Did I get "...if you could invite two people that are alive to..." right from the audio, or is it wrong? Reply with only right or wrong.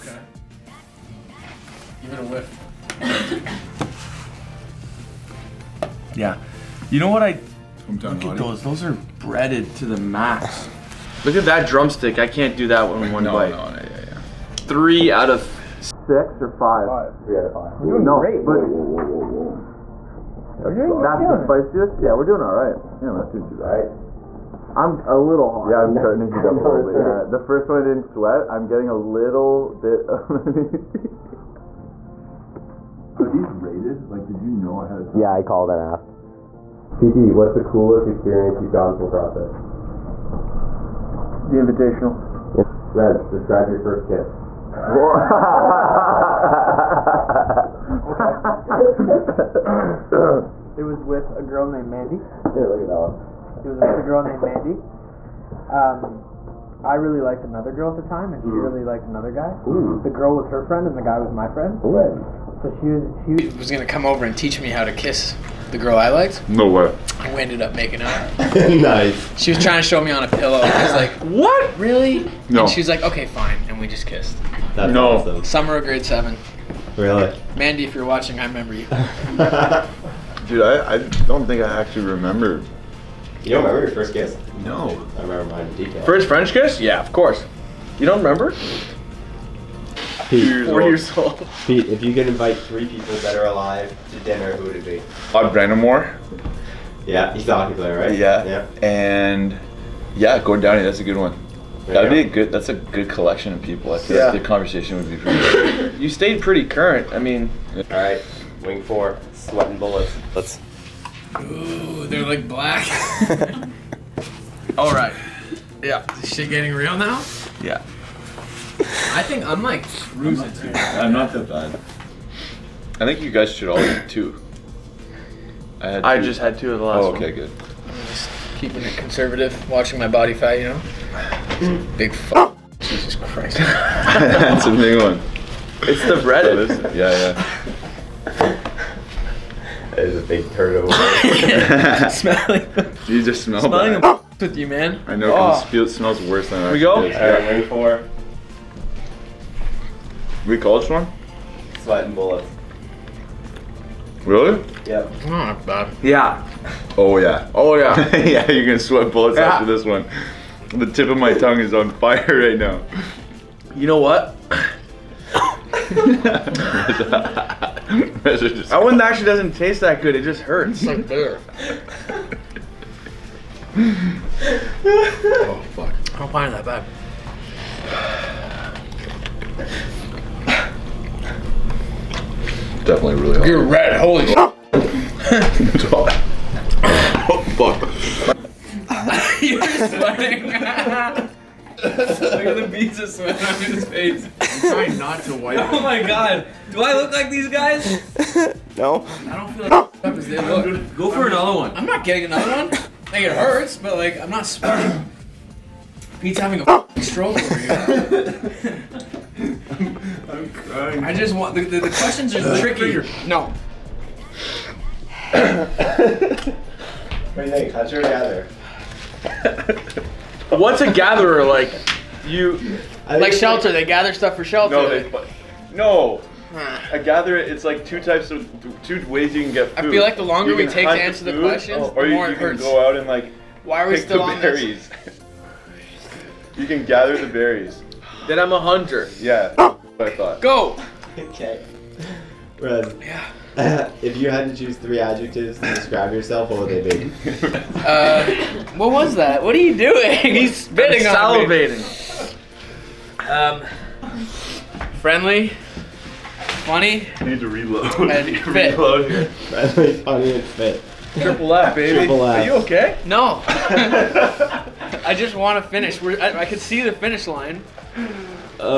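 wrong.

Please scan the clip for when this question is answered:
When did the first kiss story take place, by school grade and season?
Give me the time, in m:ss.
1:15.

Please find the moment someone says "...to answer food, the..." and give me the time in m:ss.
3:50.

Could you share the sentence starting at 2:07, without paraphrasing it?
I'm just keeping it conservative, watching my body fat, you know?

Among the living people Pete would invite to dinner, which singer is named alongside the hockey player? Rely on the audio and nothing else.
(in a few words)
Gordon Downie.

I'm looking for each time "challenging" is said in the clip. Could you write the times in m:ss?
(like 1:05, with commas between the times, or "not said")
not said.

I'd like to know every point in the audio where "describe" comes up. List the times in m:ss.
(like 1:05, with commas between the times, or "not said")
0:43, 4:05.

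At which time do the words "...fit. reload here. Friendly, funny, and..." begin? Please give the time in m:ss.
4:18.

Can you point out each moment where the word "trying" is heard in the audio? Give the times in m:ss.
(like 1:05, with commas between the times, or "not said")
1:09, 3:14.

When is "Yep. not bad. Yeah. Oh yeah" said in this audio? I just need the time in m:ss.
2:34.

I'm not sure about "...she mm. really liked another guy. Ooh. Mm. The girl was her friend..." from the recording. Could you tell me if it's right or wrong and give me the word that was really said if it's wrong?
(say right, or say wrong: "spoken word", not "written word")
right.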